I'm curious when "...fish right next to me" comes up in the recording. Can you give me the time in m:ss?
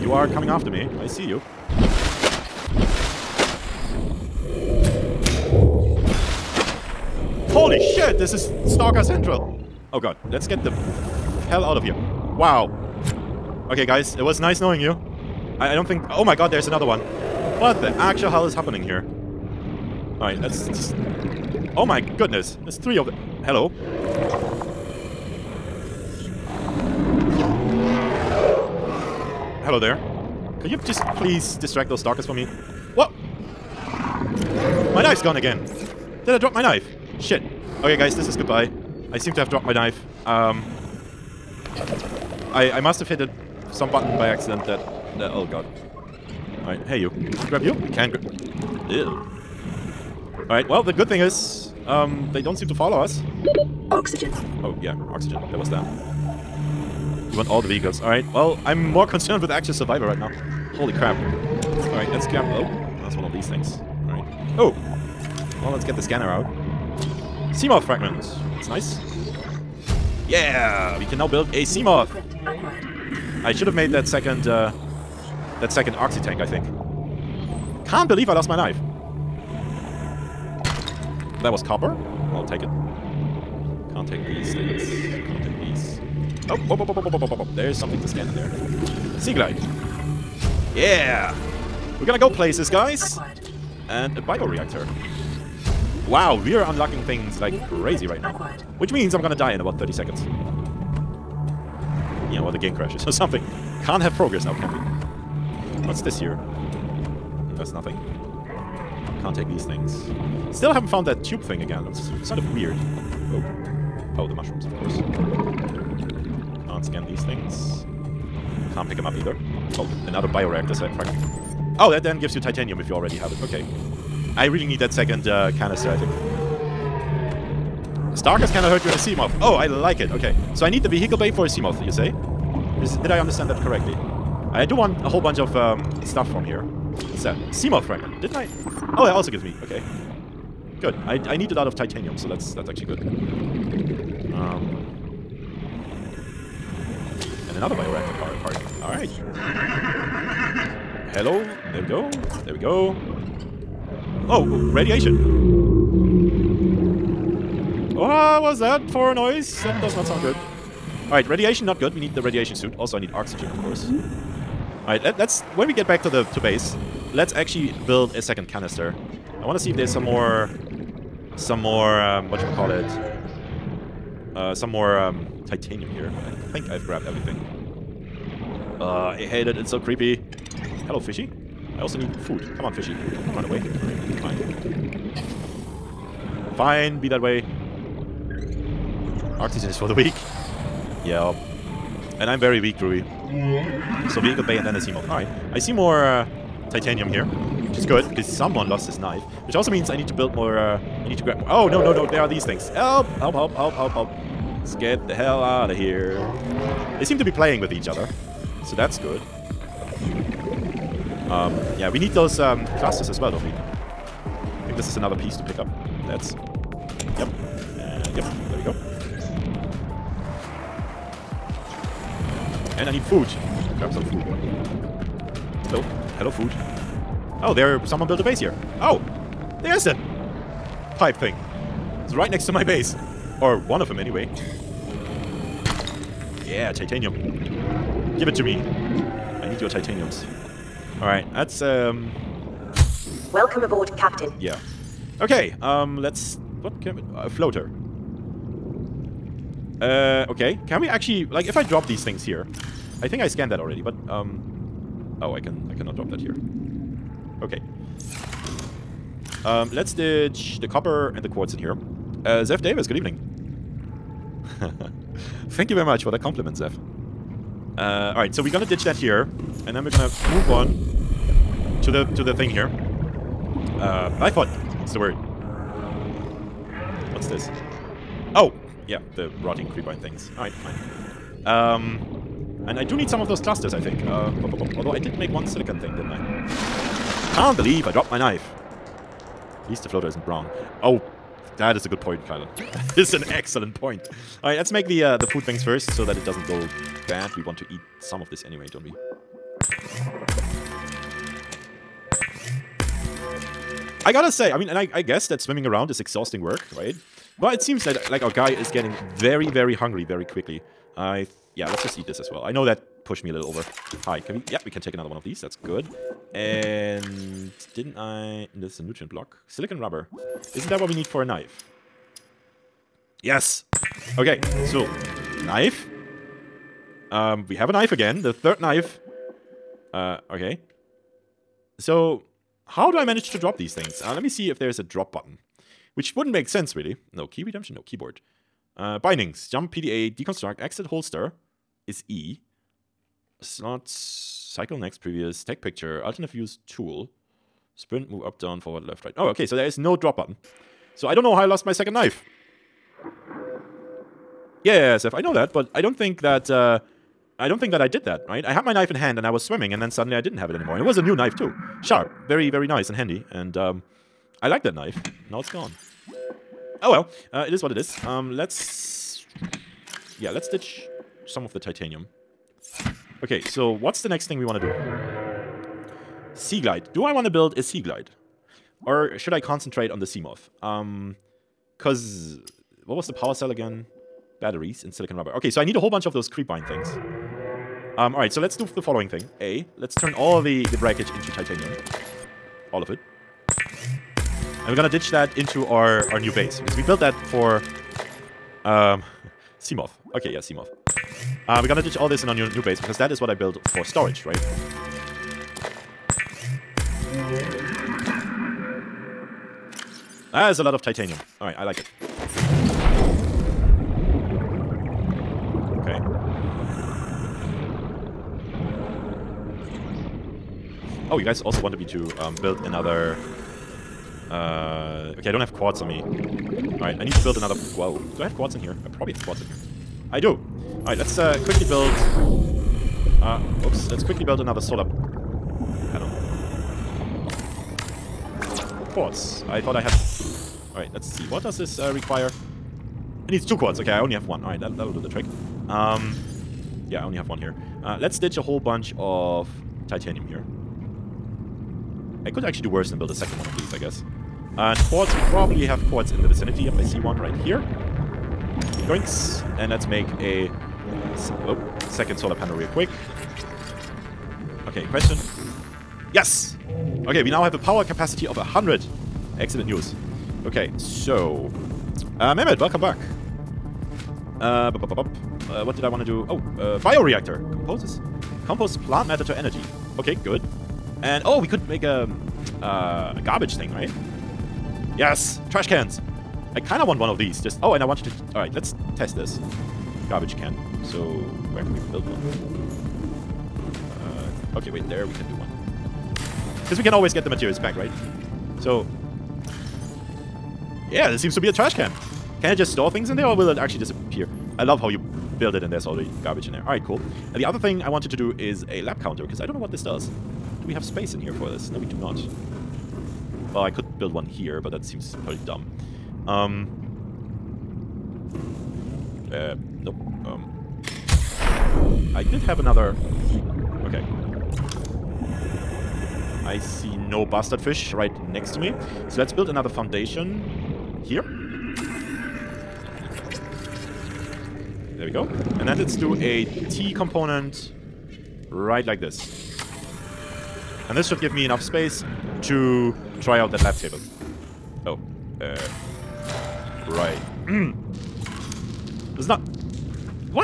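8:47.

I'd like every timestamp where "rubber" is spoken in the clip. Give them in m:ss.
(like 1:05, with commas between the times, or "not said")
5:19, 6:25.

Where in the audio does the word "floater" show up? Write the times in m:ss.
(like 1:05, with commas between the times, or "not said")
4:07, 4:49.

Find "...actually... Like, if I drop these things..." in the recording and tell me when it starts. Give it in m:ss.
4:10.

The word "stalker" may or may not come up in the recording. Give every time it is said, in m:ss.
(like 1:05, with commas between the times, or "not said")
0:08, 0:31, 2:08.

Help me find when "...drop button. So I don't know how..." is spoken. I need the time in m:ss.
5:49.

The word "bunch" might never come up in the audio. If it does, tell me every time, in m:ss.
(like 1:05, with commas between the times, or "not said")
2:15, 6:25, 7:28.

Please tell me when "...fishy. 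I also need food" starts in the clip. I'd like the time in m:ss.
3:00.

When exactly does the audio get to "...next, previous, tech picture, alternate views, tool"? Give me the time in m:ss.
5:44.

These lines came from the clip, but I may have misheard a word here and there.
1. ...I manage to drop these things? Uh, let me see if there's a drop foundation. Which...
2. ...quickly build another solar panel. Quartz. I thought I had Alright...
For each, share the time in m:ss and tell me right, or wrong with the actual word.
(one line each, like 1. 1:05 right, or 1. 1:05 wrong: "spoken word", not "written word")
1. 5:32 wrong: "button", not "foundation"
2. 7:14 right.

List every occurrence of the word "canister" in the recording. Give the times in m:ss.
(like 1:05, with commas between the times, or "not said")
2:05, 2:48.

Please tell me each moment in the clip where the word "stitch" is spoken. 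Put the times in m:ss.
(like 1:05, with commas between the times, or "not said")
6:10, 7:28.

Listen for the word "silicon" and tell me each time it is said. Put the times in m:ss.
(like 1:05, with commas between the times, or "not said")
4:45, 5:19, 6:24.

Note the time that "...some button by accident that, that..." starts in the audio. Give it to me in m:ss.
0:43.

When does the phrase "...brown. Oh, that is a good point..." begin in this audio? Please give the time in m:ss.
4:50.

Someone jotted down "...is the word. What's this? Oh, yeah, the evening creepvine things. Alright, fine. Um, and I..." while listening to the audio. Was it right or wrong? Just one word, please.
wrong.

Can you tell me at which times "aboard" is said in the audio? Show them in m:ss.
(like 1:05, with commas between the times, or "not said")
4:03.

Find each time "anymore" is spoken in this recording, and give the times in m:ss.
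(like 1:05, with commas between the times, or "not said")
6:00.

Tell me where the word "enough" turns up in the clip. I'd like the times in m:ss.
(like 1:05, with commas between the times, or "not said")
9:01.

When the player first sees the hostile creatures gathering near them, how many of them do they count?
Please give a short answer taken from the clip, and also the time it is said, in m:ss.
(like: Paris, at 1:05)
3, at 0:22.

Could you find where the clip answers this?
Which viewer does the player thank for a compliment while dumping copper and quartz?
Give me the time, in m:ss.
4:22.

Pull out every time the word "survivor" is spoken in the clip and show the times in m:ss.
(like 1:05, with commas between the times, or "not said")
0:59.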